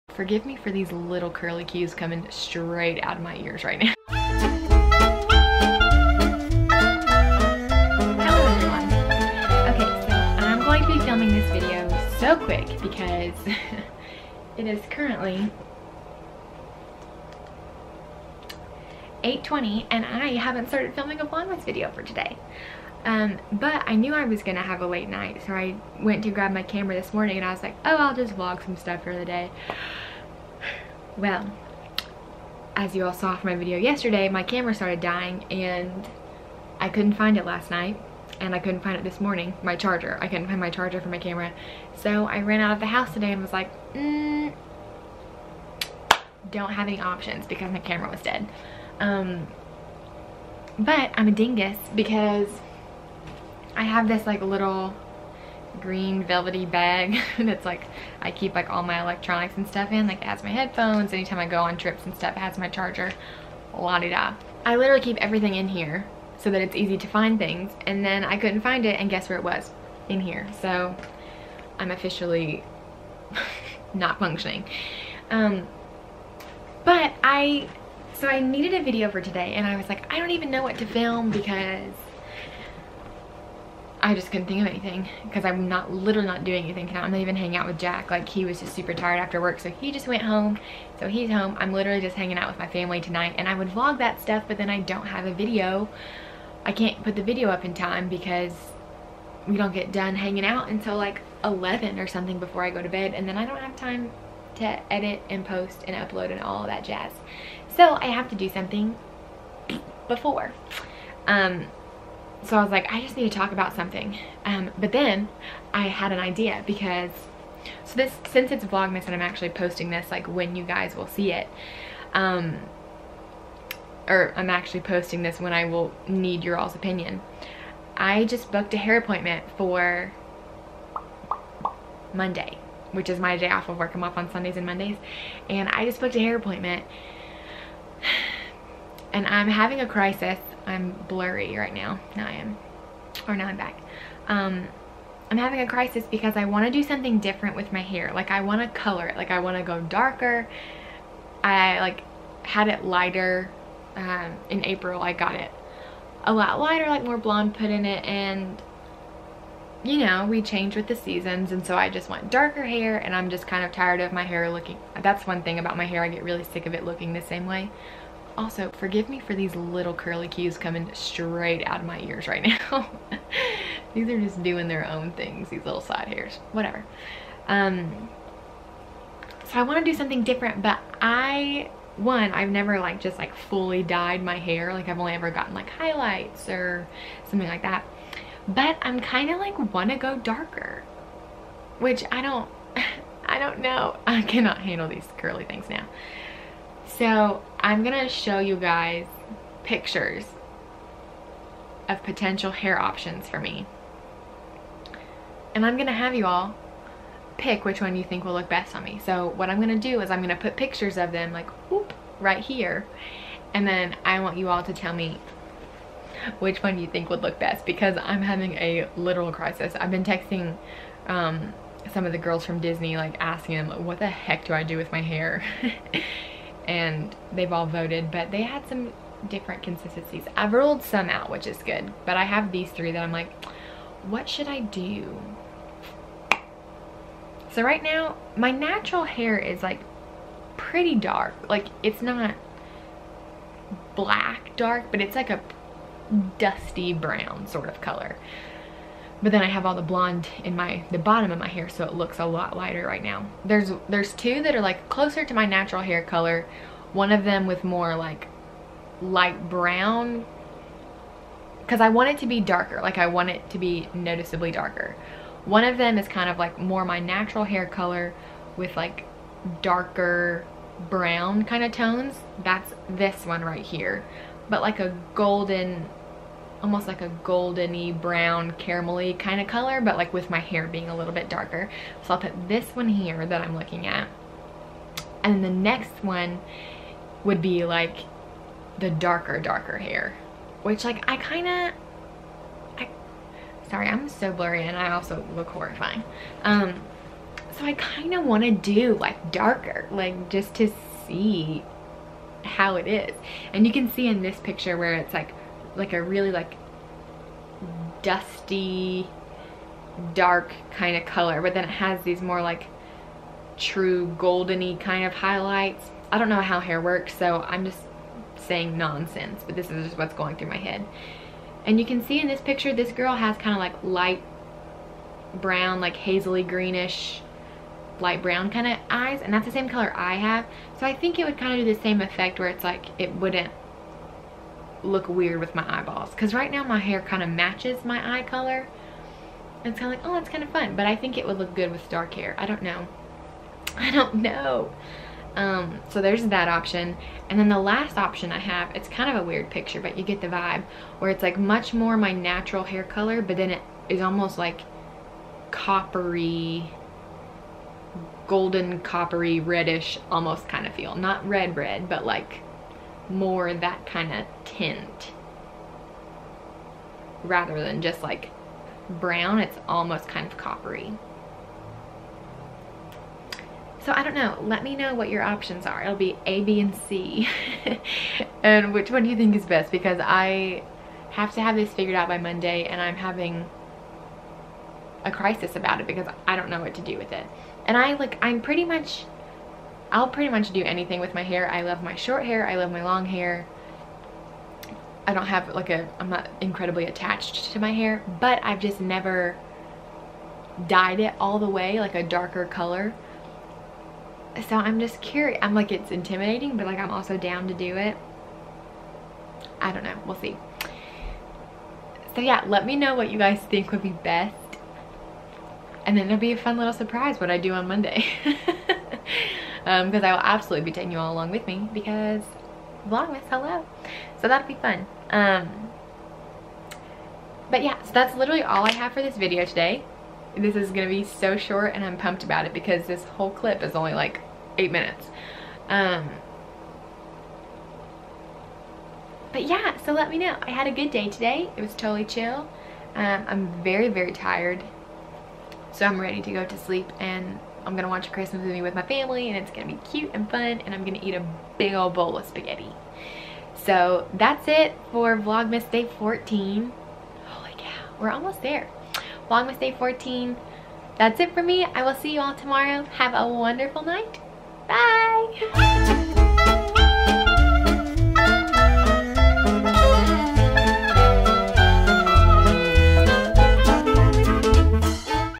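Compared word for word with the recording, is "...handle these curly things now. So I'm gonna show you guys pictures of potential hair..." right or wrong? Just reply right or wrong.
right.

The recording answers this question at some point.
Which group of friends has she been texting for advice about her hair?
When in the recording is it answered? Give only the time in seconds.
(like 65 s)
222 s.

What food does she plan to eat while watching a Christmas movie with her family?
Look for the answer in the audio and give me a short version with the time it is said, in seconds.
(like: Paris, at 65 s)
spaghetti, at 452 s.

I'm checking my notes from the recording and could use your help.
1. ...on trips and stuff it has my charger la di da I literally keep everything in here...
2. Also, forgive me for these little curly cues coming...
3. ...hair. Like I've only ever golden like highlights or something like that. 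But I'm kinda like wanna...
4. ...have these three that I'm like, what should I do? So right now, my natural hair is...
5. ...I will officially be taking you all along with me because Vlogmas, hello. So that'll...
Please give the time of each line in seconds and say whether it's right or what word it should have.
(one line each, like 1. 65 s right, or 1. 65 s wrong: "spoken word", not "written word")
1. 61 s right
2. 168 s right
3. 184 s wrong: "gotten", not "golden"
4. 232 s right
5. 420 s wrong: "absolutely", not "officially".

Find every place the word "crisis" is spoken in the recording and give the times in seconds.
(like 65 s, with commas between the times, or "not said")
139 s, 145 s, 219 s, 385 s.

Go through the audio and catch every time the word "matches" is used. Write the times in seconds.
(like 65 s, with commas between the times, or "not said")
337 s.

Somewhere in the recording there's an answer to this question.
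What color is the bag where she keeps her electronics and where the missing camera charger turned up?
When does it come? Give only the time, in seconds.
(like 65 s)
55 s.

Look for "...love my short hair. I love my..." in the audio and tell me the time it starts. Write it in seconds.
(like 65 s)
391 s.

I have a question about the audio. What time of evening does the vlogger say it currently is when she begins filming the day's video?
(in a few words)
8:20.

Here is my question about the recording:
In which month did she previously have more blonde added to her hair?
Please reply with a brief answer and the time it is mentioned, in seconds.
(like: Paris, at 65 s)
April, at 154 s.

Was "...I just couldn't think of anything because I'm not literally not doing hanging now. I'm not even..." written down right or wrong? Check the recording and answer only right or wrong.
wrong.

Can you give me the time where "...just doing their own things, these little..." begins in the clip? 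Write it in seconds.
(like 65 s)
174 s.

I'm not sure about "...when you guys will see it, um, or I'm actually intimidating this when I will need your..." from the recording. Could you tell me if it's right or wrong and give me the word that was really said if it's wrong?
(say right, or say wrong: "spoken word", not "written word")
wrong: "posting", not "intimidating".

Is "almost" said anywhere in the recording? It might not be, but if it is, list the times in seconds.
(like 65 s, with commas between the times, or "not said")
276 s, 354 s, 360 s, 369 s, 458 s.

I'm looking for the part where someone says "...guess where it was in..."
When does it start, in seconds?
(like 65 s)
69 s.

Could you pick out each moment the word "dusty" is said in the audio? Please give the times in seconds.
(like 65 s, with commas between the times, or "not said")
246 s, 308 s.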